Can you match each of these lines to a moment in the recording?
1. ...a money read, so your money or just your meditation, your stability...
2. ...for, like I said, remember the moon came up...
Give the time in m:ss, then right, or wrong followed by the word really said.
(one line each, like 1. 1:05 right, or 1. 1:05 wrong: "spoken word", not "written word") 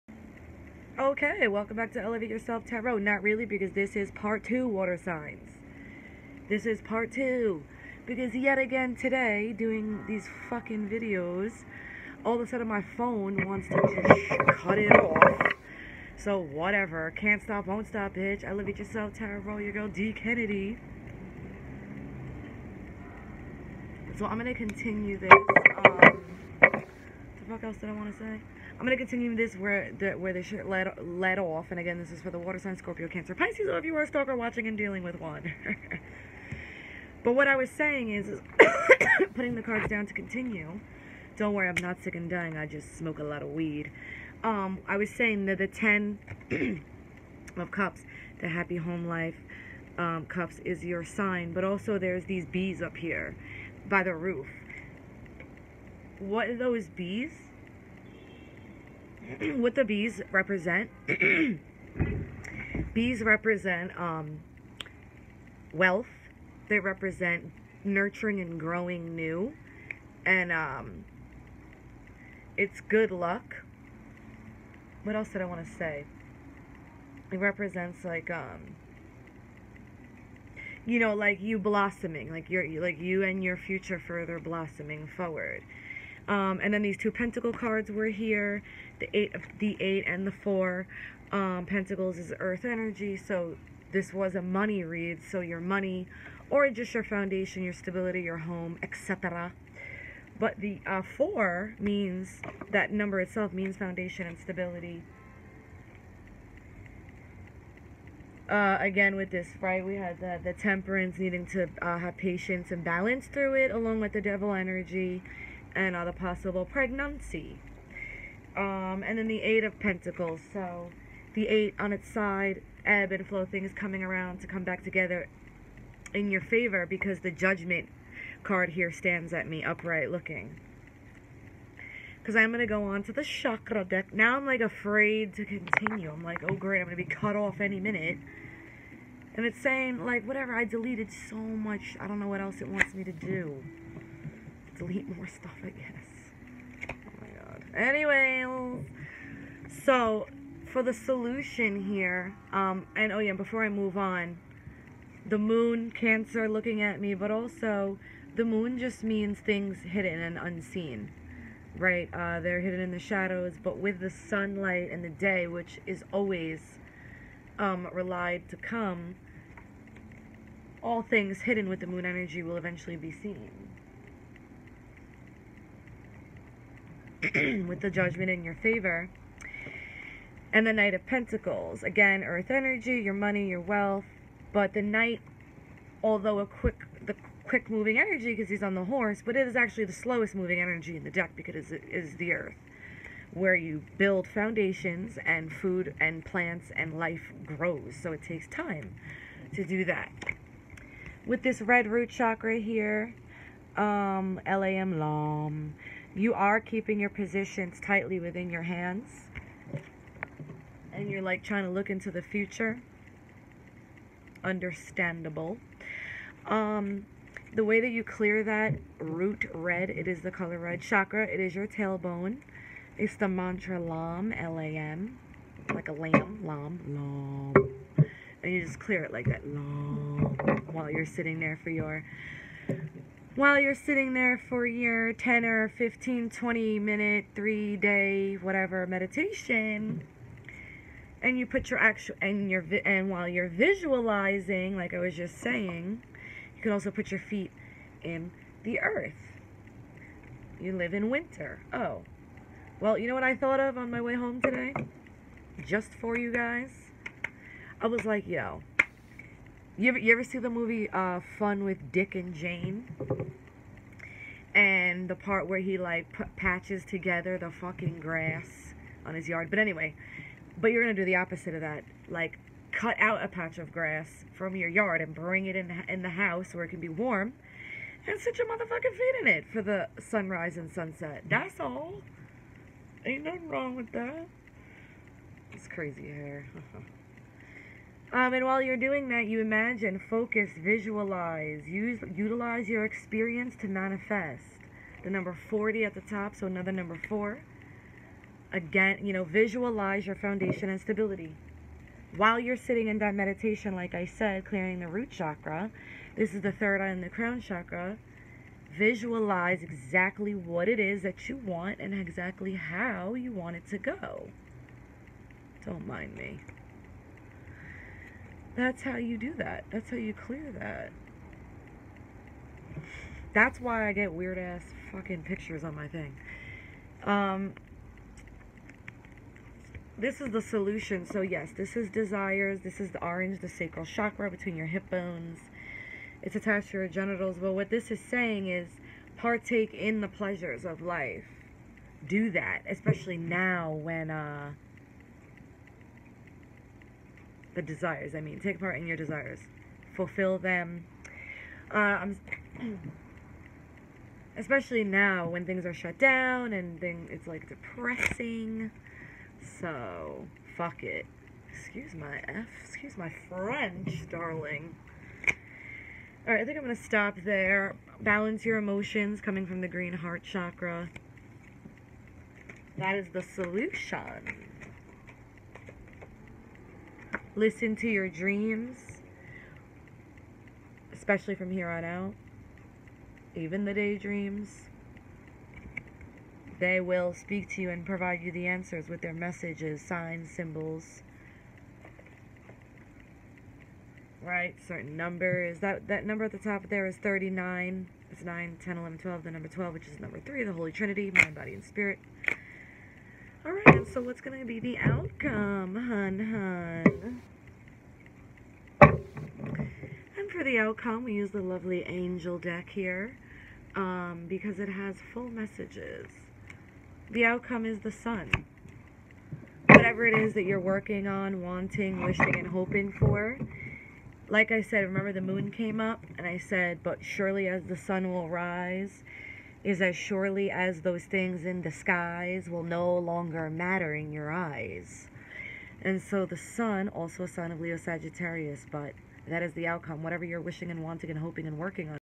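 1. 1:34 wrong: "foundation", not "meditation"
2. 7:02 right.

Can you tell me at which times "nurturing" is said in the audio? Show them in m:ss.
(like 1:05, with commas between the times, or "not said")
1:07.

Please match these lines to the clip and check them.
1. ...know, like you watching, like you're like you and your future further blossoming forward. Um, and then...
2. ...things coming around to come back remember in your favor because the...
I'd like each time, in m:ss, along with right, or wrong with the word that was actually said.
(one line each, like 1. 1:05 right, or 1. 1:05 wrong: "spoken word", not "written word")
1. 1:20 wrong: "blossoming", not "watching"
2. 2:03 wrong: "together", not "remember".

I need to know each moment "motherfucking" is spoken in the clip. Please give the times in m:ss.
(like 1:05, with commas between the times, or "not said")
4:38.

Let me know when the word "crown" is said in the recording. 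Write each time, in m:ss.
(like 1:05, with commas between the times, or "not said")
5:07.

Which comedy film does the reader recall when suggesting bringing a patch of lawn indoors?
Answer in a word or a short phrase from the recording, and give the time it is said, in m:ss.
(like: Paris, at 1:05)
Fun with Dick and Jane, at 4:21.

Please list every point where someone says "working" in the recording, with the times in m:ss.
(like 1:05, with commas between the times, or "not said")
7:00, 7:21.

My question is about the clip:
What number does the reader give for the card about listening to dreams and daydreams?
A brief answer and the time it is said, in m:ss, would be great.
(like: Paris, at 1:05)
39, at 6:36.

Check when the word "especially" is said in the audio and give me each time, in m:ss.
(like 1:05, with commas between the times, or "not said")
5:42, 5:54, 6:20.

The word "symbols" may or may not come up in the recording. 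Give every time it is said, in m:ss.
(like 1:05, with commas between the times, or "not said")
6:30.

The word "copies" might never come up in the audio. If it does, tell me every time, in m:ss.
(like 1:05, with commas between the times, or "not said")
not said.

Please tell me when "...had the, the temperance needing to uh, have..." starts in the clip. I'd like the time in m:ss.
1:49.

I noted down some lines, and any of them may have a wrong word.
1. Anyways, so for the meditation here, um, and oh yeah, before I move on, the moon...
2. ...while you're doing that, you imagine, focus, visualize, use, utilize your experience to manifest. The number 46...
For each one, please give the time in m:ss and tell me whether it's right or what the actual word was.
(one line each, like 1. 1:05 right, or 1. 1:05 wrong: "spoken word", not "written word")
1. 2:27 wrong: "solution", not "meditation"
2. 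4:48 wrong: "40", not "46".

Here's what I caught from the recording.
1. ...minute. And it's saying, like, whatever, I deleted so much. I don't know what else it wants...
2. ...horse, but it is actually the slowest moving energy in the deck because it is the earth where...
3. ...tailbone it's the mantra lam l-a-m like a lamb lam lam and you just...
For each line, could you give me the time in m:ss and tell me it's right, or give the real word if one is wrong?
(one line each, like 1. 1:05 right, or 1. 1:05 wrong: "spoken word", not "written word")
1. 2:17 right
2. 3:08 right
3. 3:41 right.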